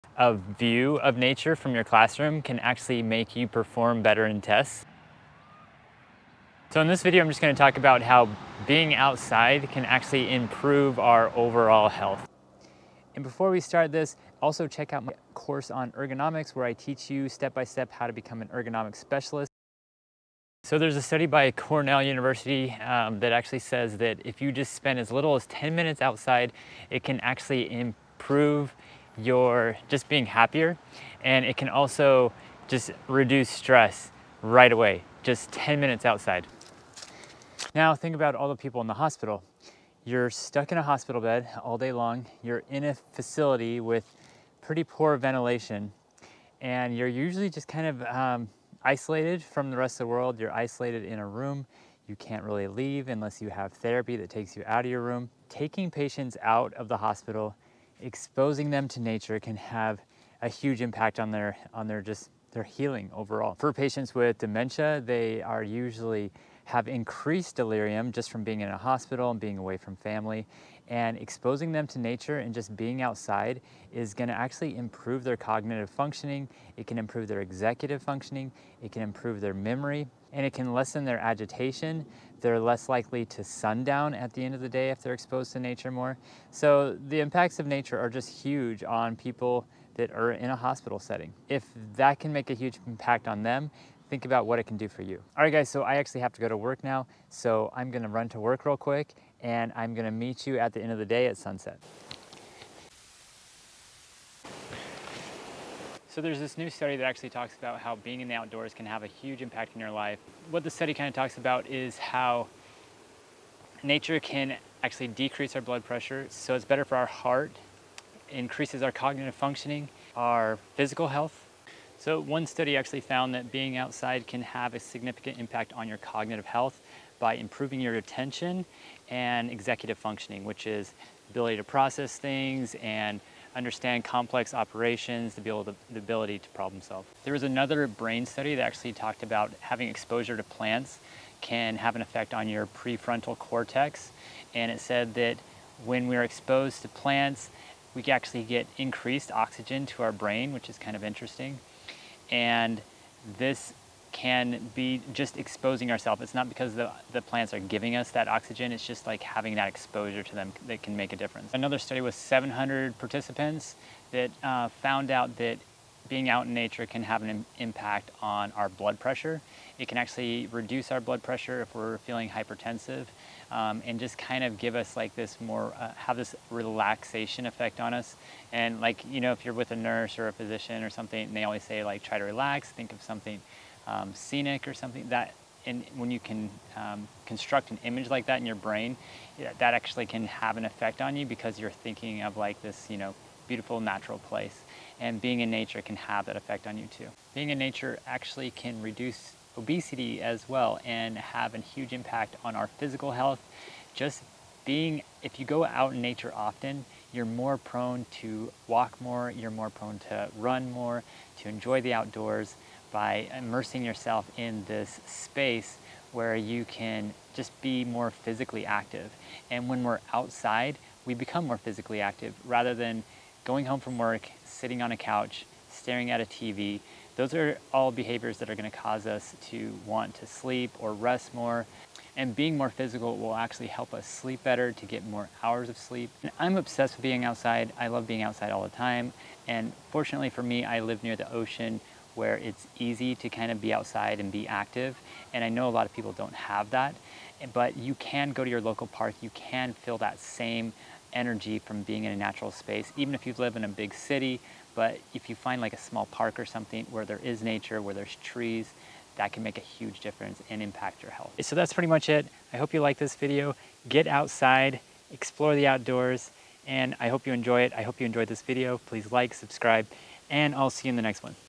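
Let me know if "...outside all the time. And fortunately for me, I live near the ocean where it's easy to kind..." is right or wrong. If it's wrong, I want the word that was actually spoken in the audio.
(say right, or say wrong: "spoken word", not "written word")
right.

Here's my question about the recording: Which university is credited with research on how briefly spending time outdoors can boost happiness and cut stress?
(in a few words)
Cornell University.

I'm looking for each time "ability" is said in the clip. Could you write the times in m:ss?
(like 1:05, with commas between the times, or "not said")
2:11, 2:15.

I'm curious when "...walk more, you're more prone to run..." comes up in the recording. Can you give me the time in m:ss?
3:28.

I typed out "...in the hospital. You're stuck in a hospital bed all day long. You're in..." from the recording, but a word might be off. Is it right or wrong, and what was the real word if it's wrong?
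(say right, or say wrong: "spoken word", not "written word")
right.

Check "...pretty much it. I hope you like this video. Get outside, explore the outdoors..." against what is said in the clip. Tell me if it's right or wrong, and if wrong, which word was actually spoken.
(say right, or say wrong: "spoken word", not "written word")
right.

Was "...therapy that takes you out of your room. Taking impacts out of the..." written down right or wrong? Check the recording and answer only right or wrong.
wrong.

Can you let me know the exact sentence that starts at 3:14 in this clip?
And being in nature can have that effect on you too.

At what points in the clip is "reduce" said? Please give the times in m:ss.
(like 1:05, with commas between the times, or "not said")
0:33, 2:50, 3:18.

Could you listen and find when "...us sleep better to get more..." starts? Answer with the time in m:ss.
3:53.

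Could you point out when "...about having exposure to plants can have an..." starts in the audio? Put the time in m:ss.
2:19.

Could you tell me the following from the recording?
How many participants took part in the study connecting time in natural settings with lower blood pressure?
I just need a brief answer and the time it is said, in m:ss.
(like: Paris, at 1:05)
700, at 2:42.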